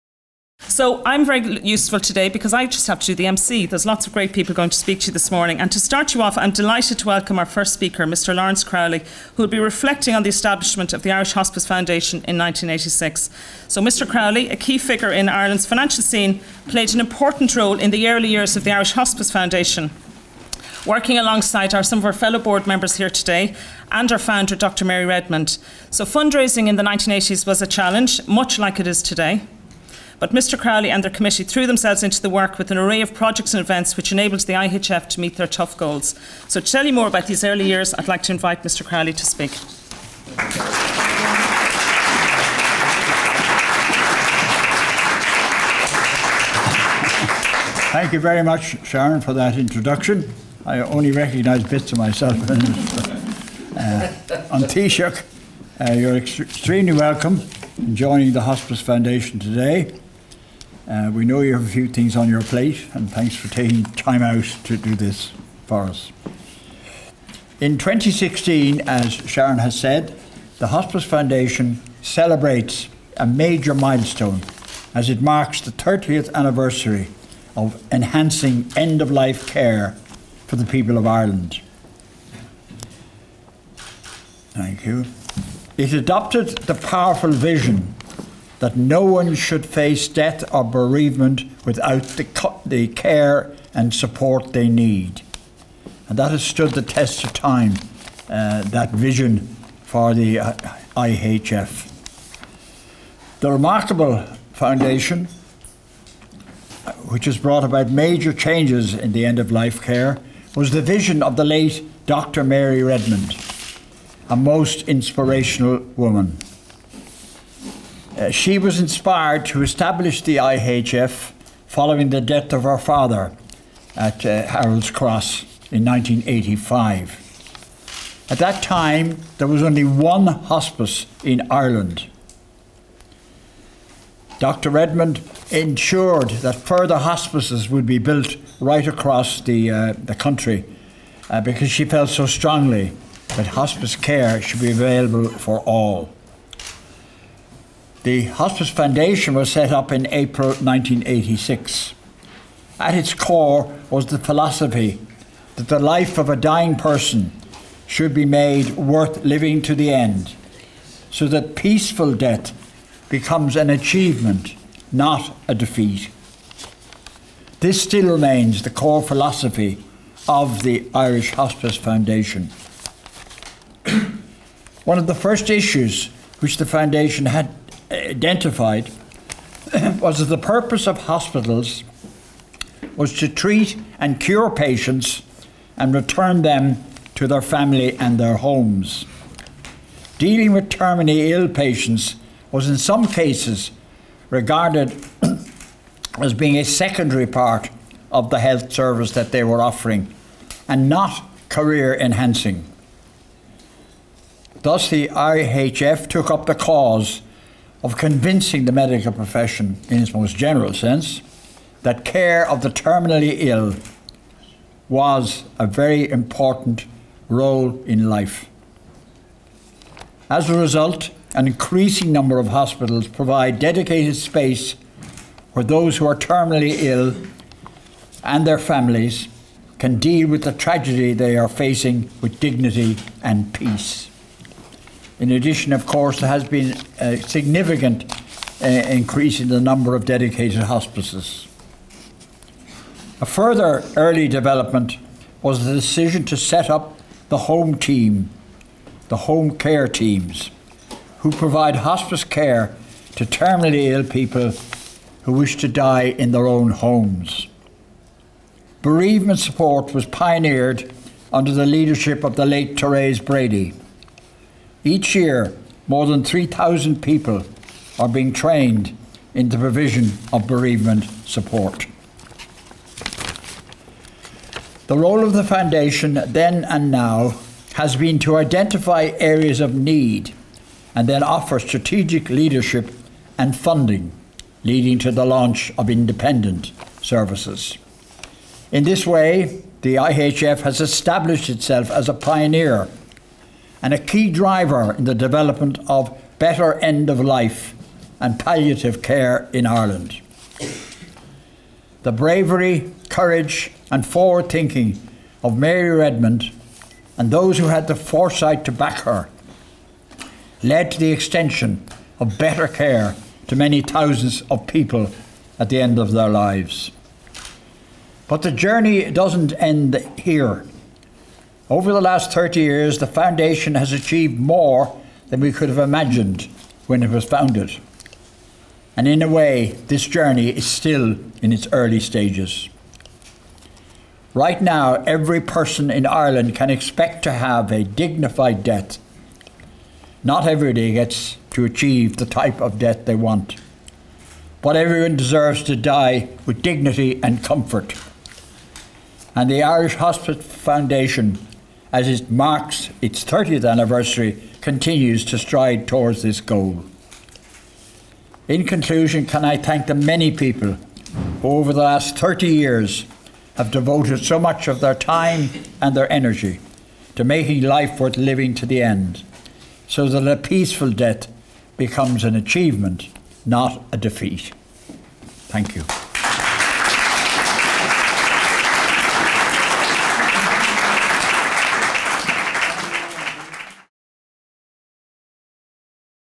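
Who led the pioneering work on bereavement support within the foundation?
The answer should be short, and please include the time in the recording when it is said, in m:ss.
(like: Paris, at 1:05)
Therese Brady, at 4:22.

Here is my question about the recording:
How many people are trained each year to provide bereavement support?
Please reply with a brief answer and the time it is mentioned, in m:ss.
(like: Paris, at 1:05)
3,000, at 4:26.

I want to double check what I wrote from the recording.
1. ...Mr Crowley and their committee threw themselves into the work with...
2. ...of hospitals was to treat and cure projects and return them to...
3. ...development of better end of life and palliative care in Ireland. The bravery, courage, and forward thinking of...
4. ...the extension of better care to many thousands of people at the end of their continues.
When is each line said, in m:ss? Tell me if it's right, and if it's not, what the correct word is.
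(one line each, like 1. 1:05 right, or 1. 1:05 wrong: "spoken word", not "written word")
1. 0:30 right
2. 3:00 wrong: "patients", not "projects"
3. 4:55 right
4. 5:10 wrong: "lives", not "continues".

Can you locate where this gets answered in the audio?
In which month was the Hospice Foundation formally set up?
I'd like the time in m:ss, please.
2:30.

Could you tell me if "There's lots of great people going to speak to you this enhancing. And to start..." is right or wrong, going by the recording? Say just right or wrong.
wrong.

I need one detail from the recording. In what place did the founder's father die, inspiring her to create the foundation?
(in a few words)
Harold's Cross.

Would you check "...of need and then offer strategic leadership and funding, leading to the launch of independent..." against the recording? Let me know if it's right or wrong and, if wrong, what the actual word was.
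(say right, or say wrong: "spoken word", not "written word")
right.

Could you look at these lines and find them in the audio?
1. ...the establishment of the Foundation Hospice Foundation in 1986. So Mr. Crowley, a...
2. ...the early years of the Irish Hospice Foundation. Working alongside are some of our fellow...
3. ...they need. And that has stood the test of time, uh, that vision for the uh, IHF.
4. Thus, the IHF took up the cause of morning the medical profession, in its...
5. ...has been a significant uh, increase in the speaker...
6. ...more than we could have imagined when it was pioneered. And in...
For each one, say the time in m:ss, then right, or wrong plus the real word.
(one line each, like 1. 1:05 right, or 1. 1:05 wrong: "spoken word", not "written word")
1. 0:10 wrong: "Irish", not "Foundation"
2. 0:17 right
3. 1:34 right
4. 3:24 wrong: "convincing", not "morning"
5. 3:56 wrong: "number", not "speaker"
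6. 5:24 wrong: "founded", not "pioneered".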